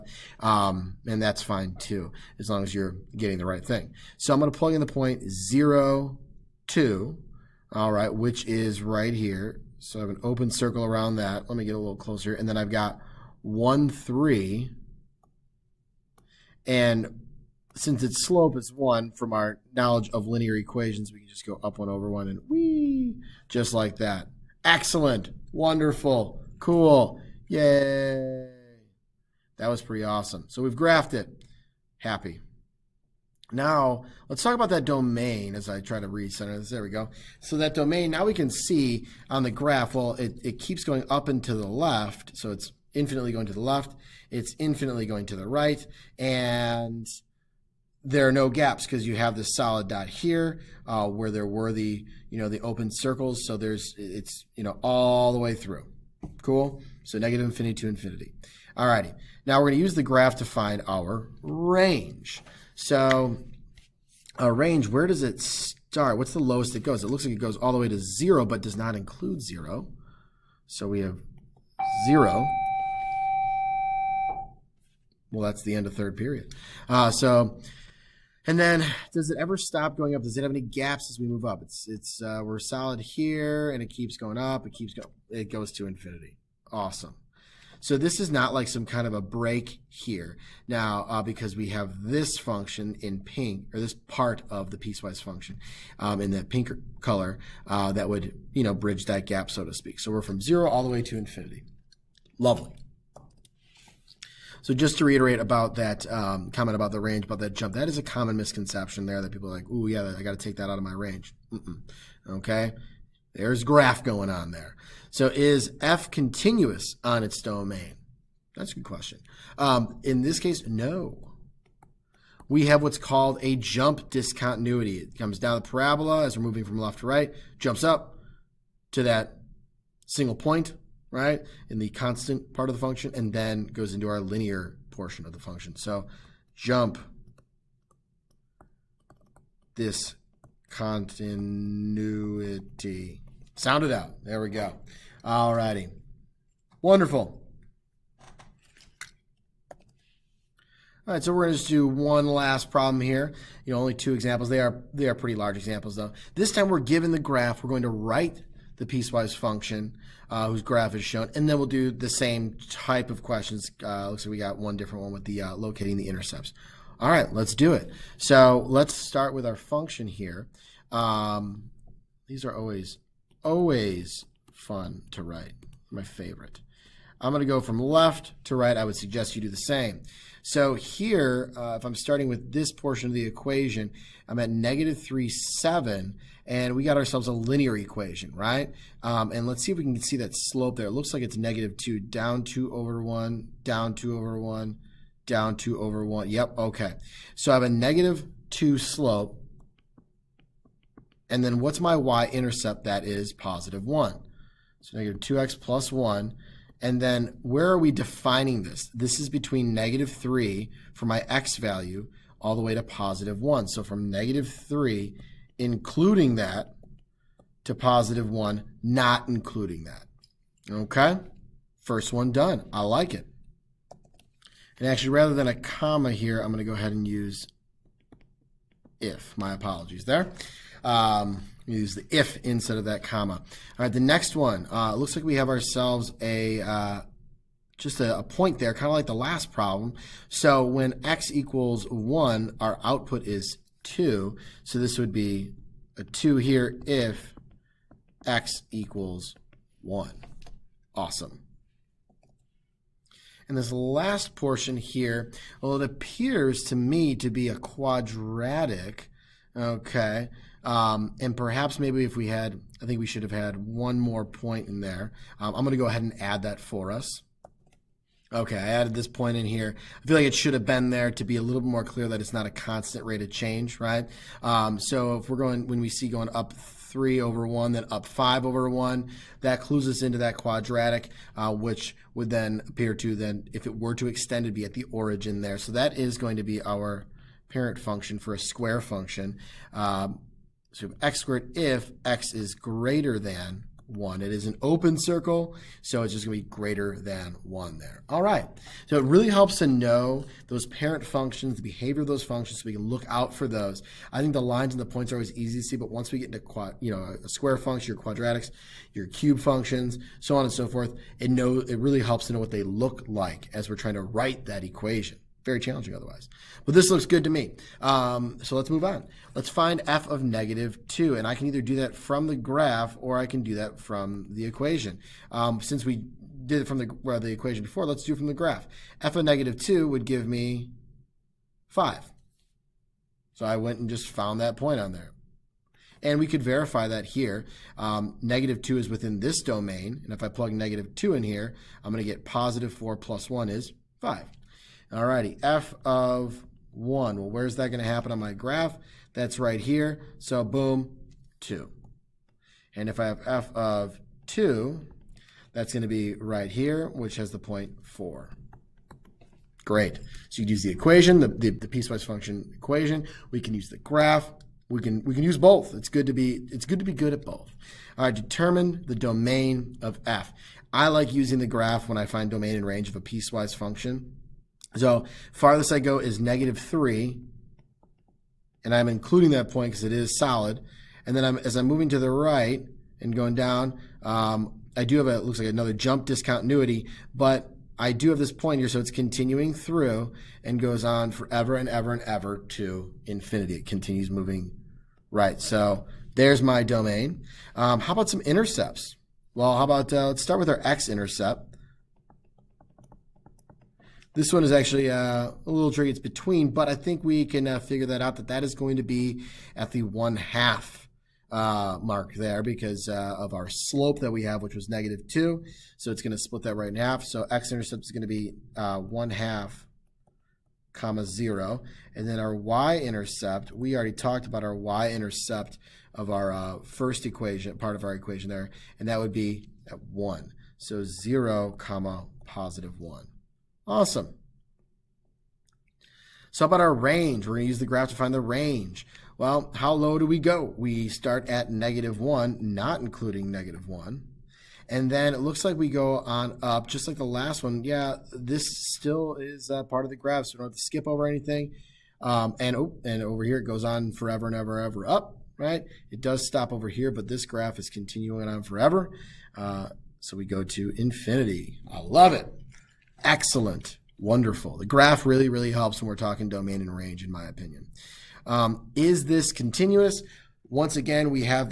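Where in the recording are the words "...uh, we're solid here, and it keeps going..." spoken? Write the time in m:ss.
1:22.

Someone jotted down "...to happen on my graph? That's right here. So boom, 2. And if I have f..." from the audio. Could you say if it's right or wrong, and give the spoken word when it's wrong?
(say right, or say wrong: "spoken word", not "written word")
right.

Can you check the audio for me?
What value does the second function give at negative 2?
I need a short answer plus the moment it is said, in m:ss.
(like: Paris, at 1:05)
5, at 5:29.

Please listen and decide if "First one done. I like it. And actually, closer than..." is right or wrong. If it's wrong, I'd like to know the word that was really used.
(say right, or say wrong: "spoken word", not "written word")
wrong: "rather", not "closer".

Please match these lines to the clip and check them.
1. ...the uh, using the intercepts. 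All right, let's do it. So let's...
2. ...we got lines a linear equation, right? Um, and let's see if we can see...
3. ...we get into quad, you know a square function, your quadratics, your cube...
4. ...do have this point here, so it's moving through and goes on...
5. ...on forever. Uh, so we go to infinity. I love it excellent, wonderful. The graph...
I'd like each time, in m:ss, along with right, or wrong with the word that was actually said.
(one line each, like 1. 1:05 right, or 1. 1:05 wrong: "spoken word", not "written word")
1. 2:45 wrong: "locating", not "using"
2. 3:06 wrong: "ourselves", not "lines"
3. 5:06 right
4. 6:27 wrong: "continuing", not "moving"
5. 7:38 right.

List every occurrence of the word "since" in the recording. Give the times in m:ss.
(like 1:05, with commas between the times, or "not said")
0:17, 5:25.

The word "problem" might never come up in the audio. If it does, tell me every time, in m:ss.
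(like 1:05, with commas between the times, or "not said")
2:32, 3:59.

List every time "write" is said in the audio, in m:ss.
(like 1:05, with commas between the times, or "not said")
2:37, 2:55, 5:14.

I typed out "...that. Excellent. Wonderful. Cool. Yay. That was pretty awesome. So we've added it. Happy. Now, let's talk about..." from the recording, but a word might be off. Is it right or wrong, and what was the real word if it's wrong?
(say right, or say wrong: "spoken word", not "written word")
wrong: "graphed", not "added".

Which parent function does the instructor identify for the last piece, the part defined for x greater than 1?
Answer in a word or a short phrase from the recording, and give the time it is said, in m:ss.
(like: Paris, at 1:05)
x squared, at 4:51.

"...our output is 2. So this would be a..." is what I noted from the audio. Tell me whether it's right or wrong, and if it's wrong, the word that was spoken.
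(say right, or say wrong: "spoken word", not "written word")
right.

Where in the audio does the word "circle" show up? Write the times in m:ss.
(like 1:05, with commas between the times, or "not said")
0:10, 0:52, 4:54.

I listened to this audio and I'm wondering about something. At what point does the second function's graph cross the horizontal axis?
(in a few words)
(1/2, 0).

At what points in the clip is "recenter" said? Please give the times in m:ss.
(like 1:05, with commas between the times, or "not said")
0:36.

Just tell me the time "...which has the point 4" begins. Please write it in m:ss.
5:56.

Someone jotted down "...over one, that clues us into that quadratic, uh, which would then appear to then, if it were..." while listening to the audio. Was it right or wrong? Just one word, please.
right.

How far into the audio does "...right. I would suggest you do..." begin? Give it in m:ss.
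2:58.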